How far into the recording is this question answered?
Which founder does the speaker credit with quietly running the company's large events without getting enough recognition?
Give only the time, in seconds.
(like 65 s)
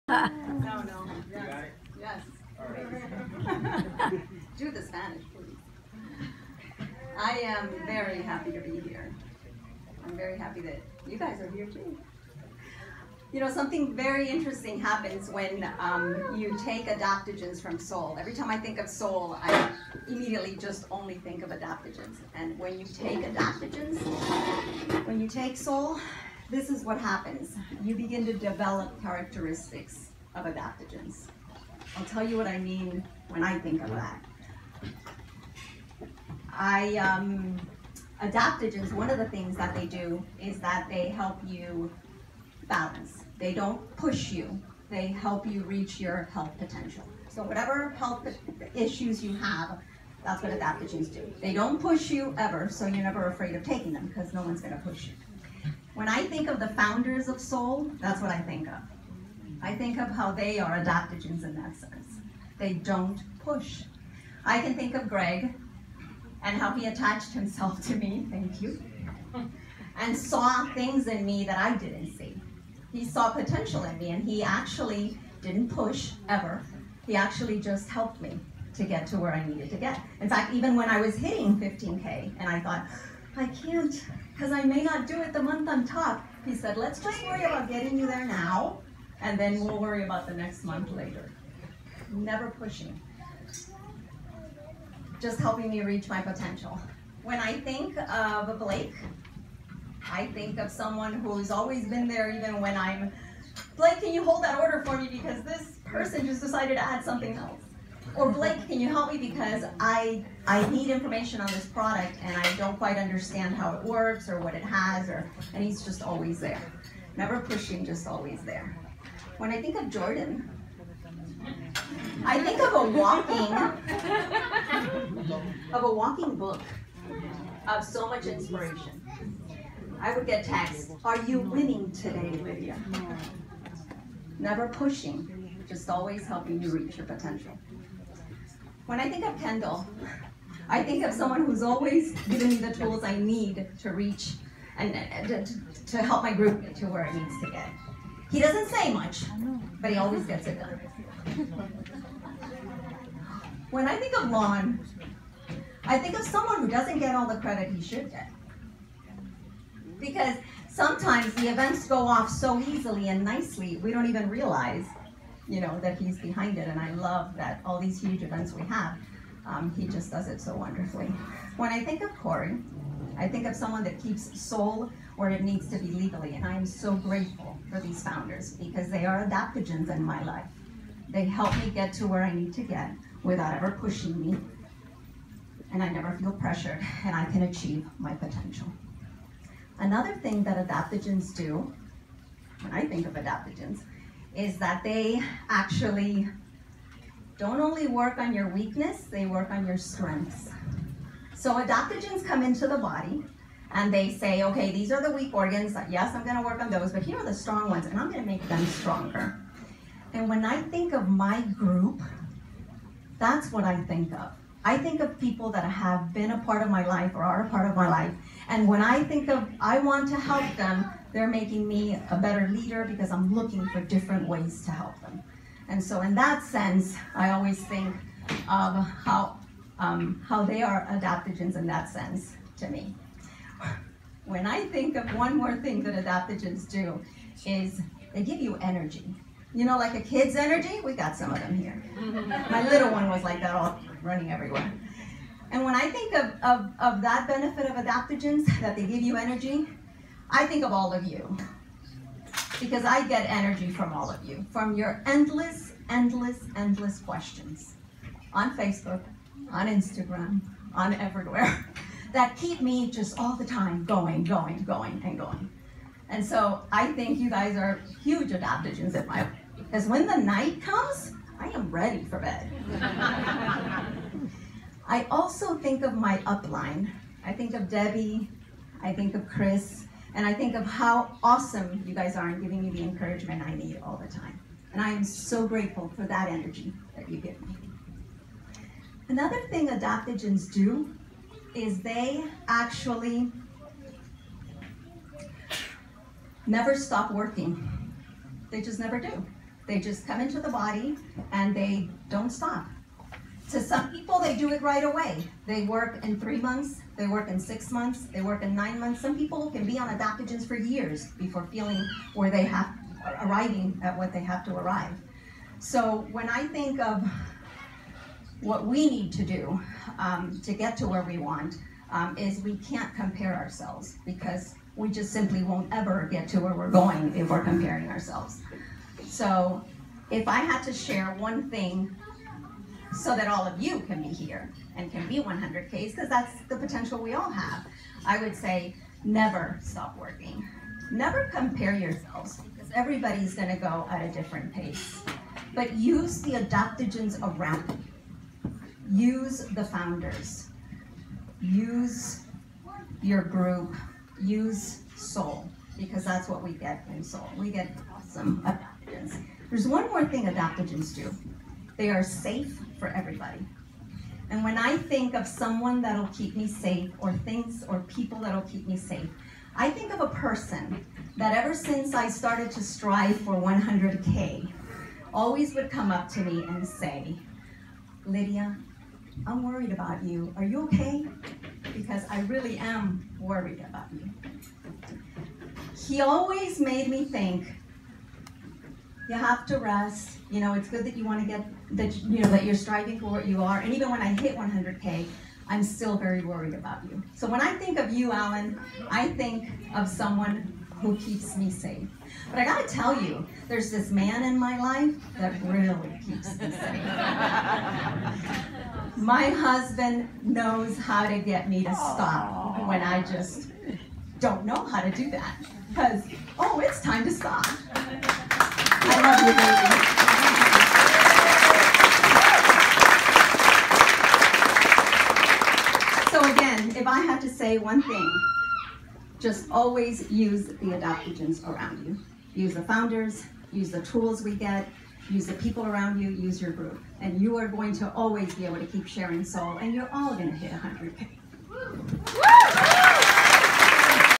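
154 s.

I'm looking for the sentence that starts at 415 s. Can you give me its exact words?
Because, oh, it's time to stop.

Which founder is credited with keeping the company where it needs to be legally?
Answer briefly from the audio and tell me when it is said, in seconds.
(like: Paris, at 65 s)
Corey, at 172 s.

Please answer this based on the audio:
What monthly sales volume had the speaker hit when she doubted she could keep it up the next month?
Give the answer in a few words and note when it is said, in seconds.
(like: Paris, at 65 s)
15K, at 81 s.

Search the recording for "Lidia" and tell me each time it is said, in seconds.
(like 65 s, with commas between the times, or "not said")
132 s, 378 s.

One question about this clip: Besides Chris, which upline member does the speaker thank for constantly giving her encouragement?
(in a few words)
Debbie.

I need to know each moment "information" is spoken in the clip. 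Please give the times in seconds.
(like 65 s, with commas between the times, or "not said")
110 s.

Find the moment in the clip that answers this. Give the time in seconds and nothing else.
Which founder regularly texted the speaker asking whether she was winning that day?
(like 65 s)
119 s.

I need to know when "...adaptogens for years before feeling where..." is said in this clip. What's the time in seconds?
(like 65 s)
309 s.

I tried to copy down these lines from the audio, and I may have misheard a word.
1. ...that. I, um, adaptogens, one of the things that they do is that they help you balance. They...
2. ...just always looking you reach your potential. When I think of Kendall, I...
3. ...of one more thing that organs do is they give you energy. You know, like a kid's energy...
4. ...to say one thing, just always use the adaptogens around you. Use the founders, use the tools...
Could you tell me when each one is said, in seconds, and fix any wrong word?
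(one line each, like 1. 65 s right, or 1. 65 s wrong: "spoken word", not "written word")
1. 33 s right
2. 135 s wrong: "helping", not "looking"
3. 234 s wrong: "adaptogens", not "organs"
4. 427 s right.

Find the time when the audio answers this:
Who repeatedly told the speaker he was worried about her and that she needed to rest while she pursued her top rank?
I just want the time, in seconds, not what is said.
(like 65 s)
398 s.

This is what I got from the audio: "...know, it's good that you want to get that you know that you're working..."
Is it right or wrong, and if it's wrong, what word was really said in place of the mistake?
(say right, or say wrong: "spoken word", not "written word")
wrong: "striving", not "working".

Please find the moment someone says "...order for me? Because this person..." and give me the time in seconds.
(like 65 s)
104 s.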